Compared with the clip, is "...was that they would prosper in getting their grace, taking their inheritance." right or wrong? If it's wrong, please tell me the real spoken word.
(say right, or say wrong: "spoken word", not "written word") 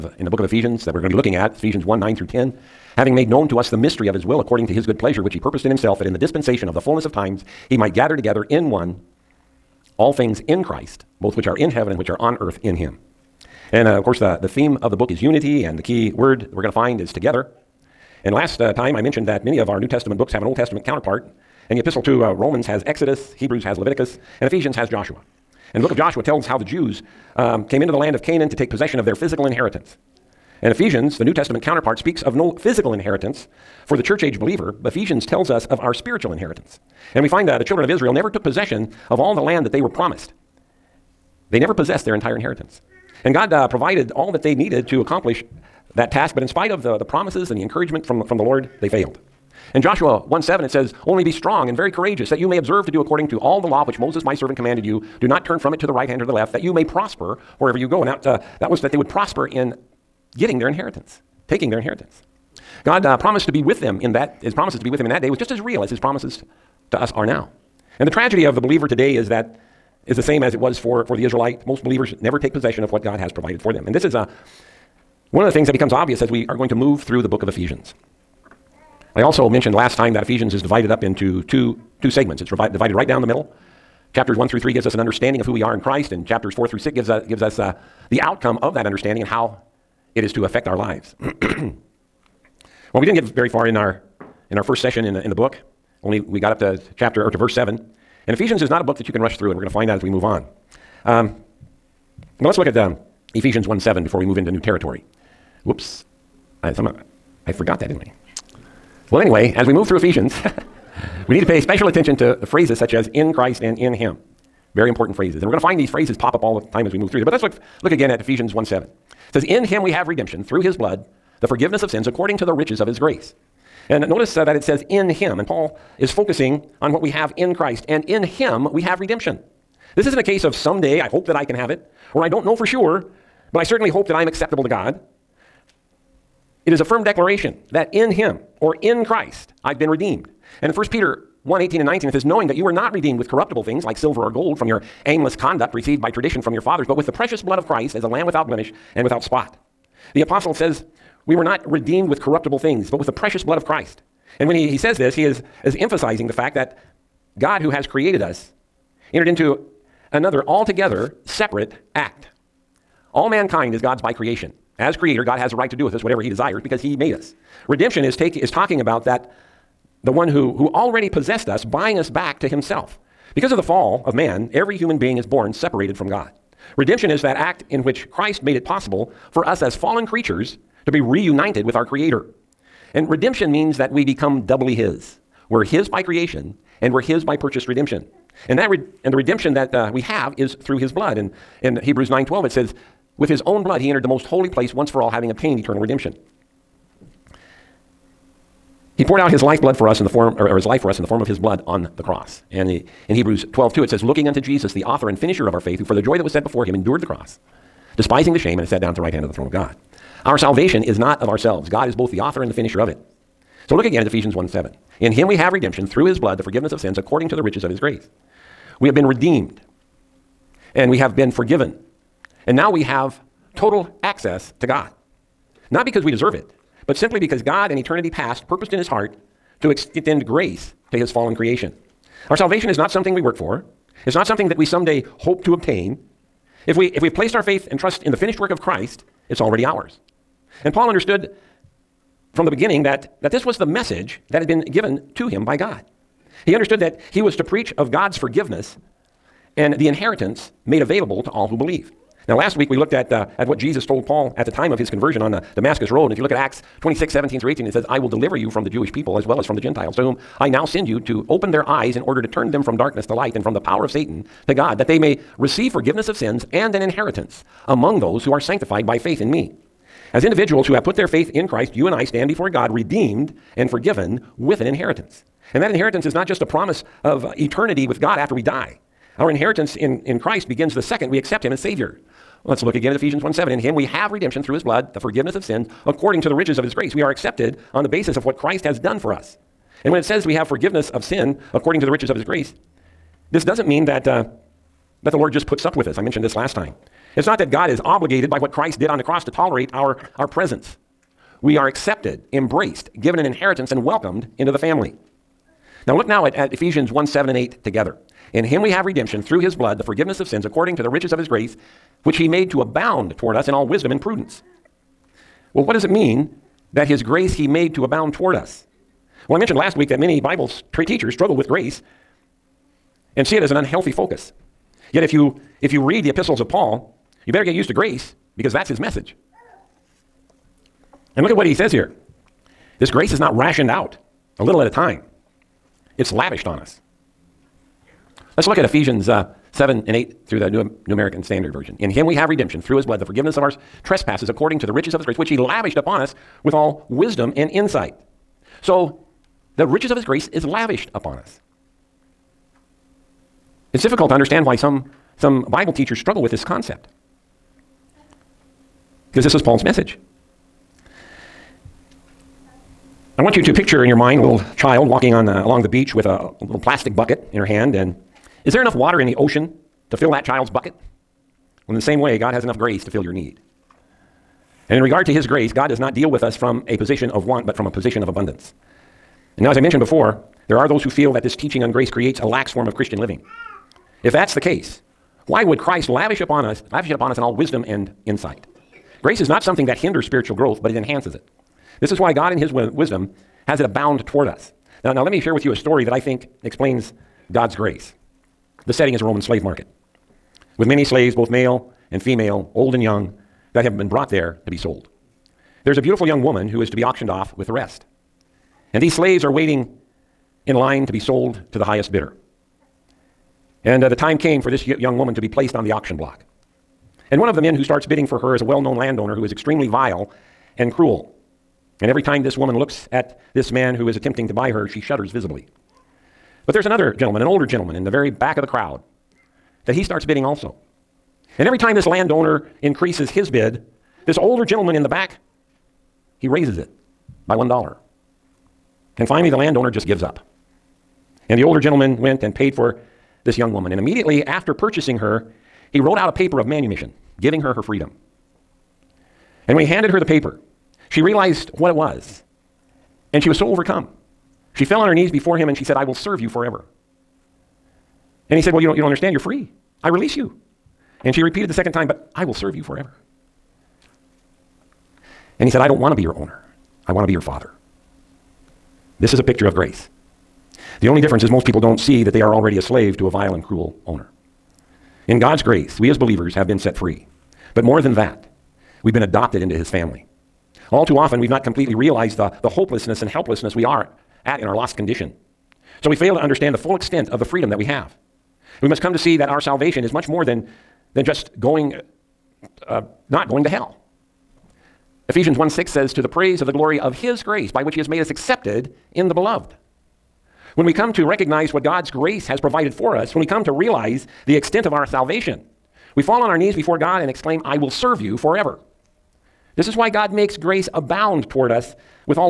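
wrong: "inheritance", not "grace".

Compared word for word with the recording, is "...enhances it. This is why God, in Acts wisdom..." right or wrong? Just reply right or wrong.
wrong.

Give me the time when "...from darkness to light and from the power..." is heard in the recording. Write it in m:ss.
4:22.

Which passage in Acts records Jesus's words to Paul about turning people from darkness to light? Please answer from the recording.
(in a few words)
Acts 26:17-18.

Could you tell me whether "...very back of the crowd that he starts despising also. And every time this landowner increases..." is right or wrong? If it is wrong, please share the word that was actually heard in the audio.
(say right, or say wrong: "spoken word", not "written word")
wrong: "bidding", not "despising".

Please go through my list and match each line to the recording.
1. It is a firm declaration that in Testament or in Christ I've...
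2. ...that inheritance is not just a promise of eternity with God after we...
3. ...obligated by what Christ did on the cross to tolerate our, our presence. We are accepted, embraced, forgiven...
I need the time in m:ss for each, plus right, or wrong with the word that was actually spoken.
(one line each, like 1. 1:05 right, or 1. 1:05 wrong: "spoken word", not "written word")
1. 2:16 wrong: "Him", not "Testament"
2. 4:35 right
3. 4:57 wrong: "given", not "forgiven".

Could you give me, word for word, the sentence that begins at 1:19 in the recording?
I also mentioned last time that Ephesians is divided up into two, two segments.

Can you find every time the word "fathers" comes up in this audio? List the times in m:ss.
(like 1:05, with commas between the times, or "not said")
2:26, 7:47.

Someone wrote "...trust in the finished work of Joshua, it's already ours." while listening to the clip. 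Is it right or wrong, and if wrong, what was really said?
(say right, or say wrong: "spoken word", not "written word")
wrong: "Christ", not "Joshua".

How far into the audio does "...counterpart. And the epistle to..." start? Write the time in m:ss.
0:20.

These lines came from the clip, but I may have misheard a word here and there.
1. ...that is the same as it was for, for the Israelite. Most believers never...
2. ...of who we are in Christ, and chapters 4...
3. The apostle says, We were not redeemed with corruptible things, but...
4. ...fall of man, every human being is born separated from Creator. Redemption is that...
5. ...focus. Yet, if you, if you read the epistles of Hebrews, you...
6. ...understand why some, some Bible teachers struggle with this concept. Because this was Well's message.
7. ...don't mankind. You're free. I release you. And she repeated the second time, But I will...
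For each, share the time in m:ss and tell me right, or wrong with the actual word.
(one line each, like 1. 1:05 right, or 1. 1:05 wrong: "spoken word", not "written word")
1. 1:09 right
2. 1:25 right
3. 2:30 right
4. 2:53 wrong: "God", not "Creator"
5. 5:23 wrong: "Paul", not "Hebrews"
6. 5:54 wrong: "Paul", not "Well"
7. 7:38 wrong: "understand", not "mankind".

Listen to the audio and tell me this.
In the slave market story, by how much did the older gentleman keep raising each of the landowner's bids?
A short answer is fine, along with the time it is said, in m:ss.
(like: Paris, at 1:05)
1 dollar, at 7:17.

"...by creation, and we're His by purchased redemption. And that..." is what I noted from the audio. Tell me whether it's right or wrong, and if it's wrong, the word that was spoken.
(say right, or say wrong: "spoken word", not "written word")
right.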